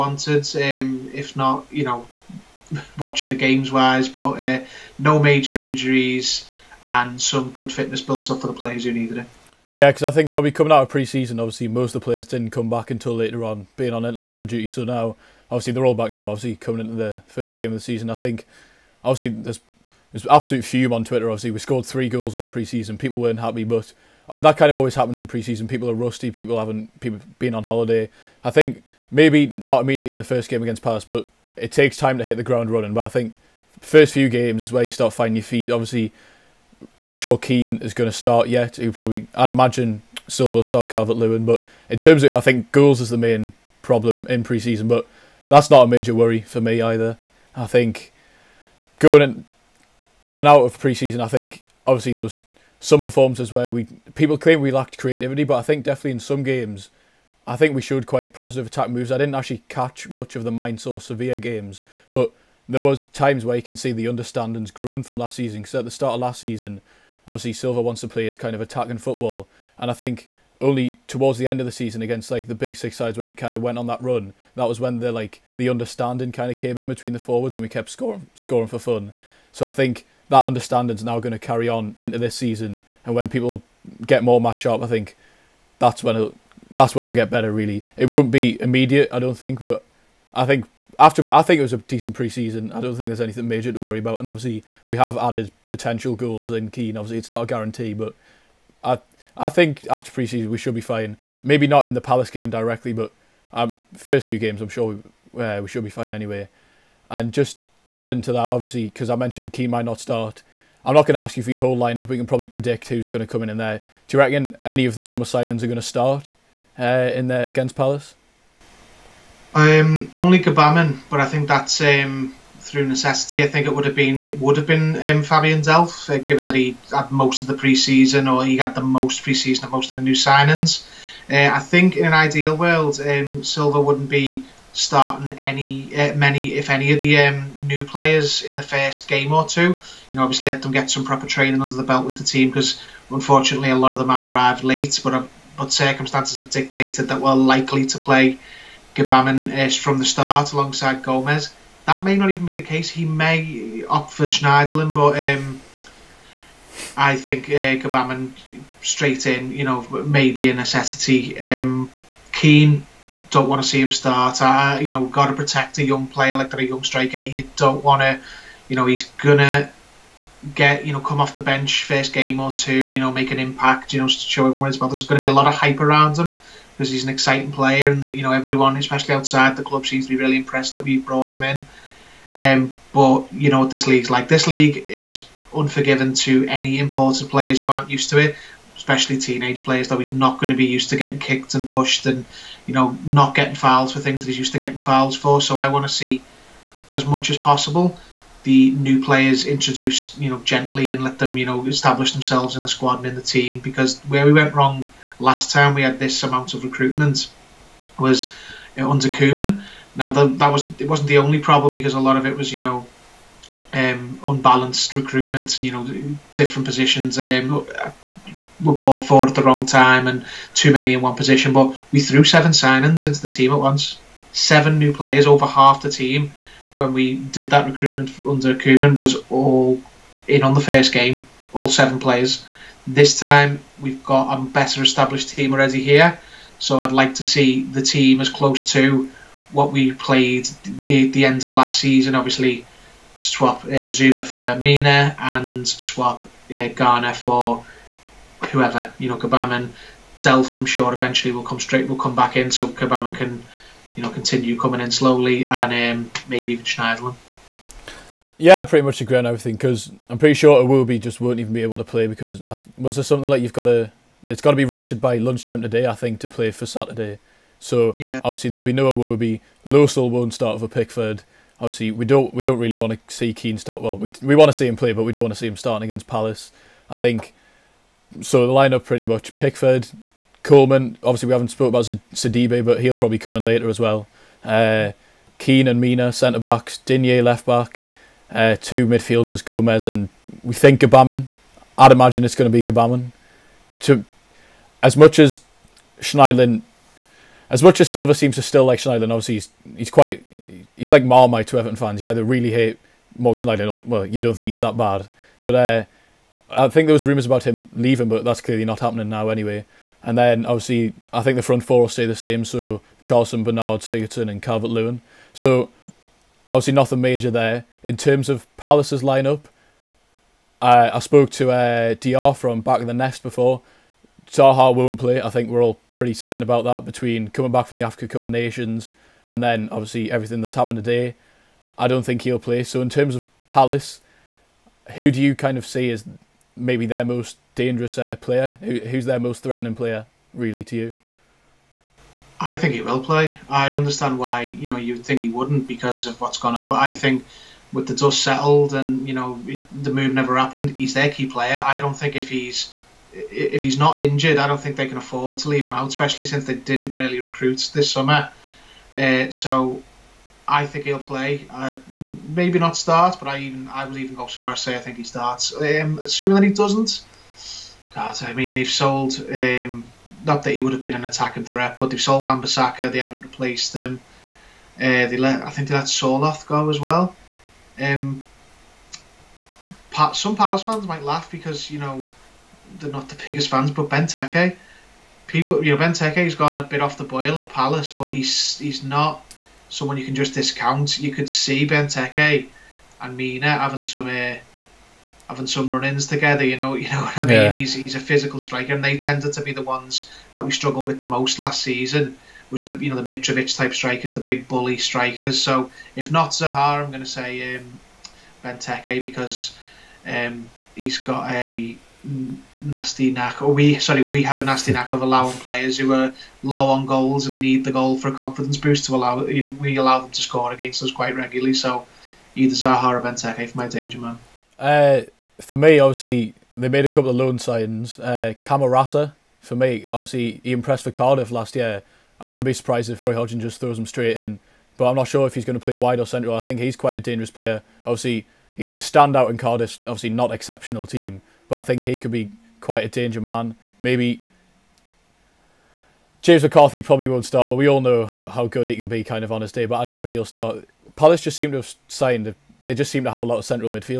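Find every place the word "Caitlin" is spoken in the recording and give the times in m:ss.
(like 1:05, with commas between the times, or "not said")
not said.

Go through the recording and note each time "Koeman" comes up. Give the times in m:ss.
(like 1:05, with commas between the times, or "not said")
3:29, 3:48.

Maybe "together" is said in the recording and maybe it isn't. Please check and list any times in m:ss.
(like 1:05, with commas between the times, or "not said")
6:36.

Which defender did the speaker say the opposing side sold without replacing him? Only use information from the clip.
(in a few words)
Wan Bissaka.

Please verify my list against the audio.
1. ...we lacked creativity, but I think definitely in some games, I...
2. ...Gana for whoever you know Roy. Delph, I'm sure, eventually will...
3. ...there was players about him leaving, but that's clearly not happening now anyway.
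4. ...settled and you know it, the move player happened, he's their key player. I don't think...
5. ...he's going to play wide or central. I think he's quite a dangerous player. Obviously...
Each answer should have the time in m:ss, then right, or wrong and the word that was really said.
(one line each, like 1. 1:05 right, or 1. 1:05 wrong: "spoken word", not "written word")
1. 0:54 right
2. 4:06 wrong: "Gbamin", not "Roy"
3. 5:06 wrong: "rumours", not "players"
4. 5:48 wrong: "never", not "player"
5. 7:15 right.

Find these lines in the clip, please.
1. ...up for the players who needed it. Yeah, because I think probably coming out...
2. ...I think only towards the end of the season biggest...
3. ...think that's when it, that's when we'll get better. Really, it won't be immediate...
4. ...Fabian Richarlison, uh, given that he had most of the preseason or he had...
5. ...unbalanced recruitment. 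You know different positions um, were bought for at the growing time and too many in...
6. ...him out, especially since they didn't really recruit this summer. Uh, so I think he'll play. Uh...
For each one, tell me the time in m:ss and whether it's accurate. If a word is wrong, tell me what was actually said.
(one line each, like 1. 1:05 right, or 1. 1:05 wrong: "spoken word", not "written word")
1. 0:08 right
2. 1:09 wrong: "against", not "biggest"
3. 1:24 right
4. 2:05 wrong: "Delph", not "Richarlison"
5. 3:34 wrong: "wrong", not "growing"
6. 5:55 right.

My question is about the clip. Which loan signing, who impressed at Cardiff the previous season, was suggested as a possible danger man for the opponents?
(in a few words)
Camarasa.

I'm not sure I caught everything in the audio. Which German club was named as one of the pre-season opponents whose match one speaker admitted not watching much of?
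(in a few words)
Mainz.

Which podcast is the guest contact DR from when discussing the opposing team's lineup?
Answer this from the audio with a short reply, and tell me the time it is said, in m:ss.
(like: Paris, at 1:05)
Back in the Nest, at 5:22.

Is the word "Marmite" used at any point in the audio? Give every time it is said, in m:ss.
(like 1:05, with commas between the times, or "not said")
5:01.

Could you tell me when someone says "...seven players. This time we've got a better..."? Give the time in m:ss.
3:51.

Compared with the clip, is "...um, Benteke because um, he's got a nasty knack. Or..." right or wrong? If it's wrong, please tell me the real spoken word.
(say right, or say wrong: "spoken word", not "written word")
right.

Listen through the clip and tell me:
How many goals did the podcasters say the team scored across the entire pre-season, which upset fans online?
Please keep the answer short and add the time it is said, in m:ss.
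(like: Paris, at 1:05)
3, at 0:21.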